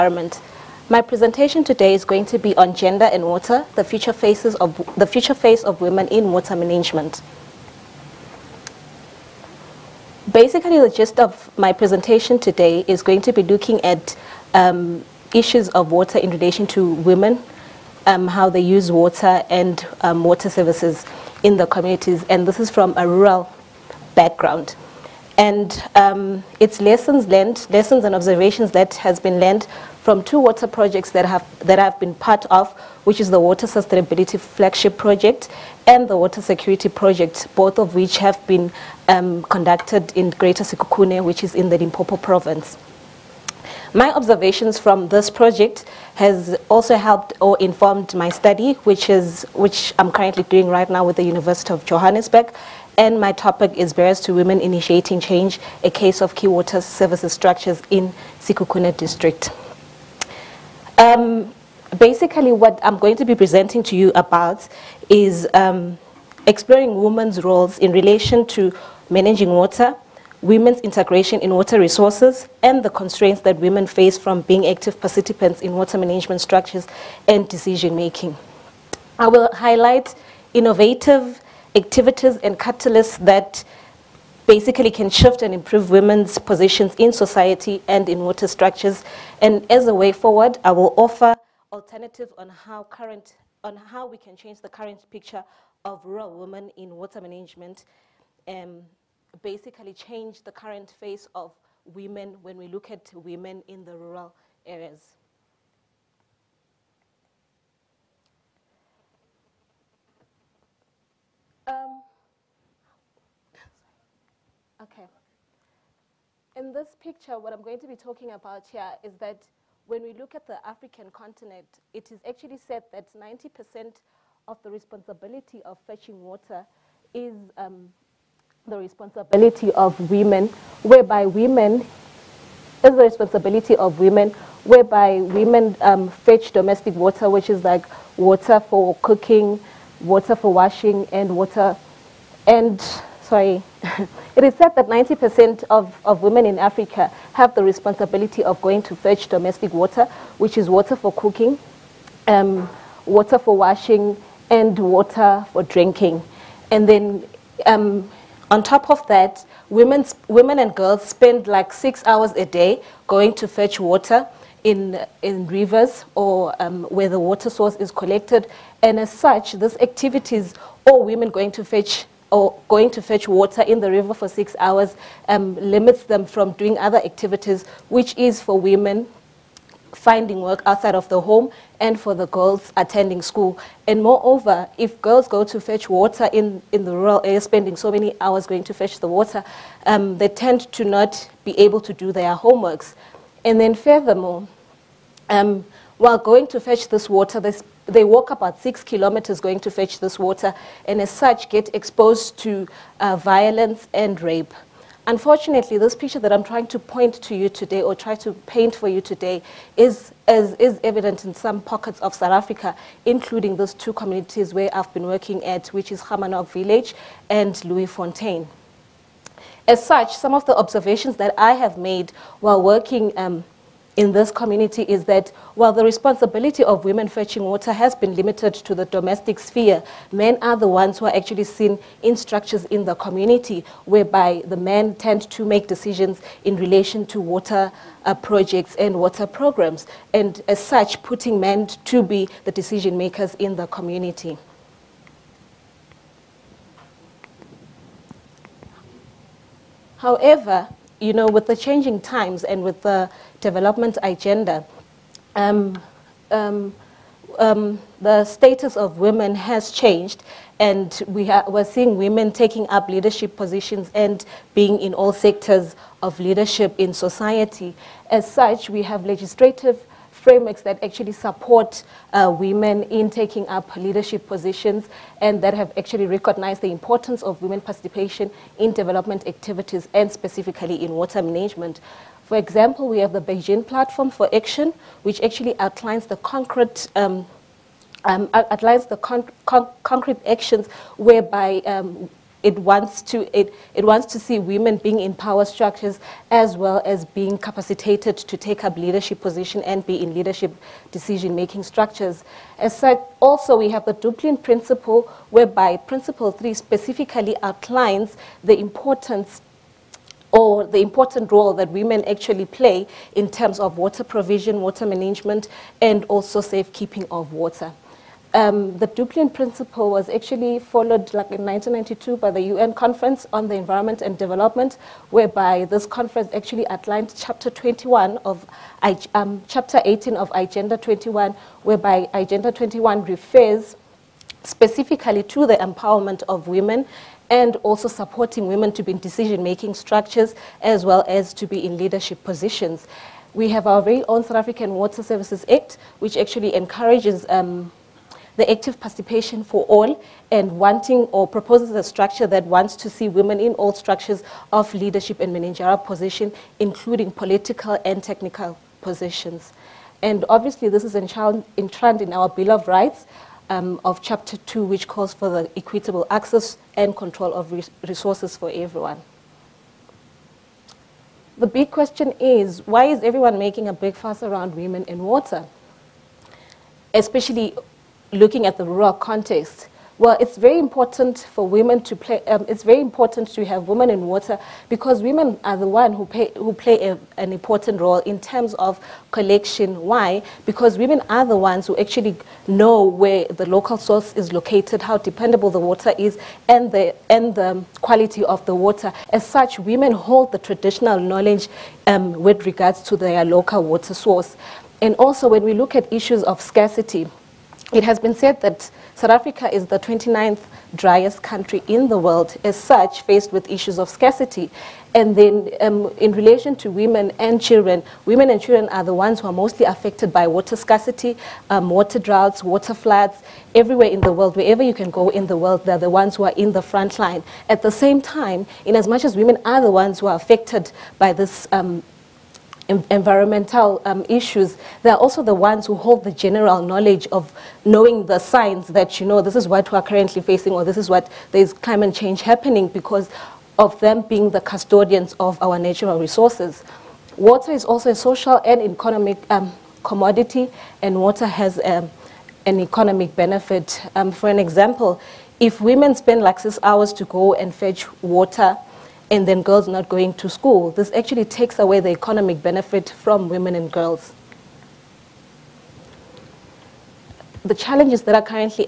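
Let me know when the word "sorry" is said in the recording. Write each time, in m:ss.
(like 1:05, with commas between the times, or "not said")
2:23.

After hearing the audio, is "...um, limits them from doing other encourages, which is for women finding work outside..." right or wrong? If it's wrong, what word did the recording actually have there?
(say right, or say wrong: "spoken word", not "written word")
wrong: "activities", not "encourages".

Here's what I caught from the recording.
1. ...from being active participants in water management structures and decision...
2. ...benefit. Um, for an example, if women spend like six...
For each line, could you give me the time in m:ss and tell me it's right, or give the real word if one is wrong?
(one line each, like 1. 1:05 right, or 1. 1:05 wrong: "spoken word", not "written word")
1. 1:14 right
2. 7:33 right.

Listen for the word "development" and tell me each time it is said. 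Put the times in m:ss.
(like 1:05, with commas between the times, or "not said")
4:13, 4:38, 5:24.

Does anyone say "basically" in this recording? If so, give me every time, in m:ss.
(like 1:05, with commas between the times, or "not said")
0:10, 1:01, 1:24, 1:39.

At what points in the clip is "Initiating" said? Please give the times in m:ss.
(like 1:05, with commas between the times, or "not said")
0:54.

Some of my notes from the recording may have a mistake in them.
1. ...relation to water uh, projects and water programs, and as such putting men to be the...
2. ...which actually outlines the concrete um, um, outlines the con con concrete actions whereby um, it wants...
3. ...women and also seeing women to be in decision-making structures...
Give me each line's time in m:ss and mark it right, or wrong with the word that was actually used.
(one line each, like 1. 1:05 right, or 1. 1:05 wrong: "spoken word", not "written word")
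1. 3:56 right
2. 4:45 right
3. 5:36 wrong: "supporting", not "seeing".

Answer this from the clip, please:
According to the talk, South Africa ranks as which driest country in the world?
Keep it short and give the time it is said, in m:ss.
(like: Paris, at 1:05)
29th, at 6:49.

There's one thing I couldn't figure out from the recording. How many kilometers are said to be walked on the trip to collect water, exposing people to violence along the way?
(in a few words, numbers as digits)
6.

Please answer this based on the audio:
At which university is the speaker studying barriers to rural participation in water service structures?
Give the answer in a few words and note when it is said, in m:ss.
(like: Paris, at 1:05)
University of Johannesburg, at 0:51.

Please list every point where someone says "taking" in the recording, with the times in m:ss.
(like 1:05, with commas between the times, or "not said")
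4:22, 4:33.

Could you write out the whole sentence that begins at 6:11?
The big question is, why is everyone making a big fuss around women and water?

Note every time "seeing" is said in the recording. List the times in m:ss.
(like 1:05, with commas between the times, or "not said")
4:21.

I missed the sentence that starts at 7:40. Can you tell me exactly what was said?
This actually takes away the economic benefit from women and girls.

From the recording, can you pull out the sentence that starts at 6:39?
As such, women hold the traditional knowledge um, with regards to their local water source.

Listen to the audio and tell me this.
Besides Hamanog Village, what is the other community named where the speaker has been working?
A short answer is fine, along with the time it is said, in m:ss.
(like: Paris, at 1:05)
Leeufontein, at 3:37.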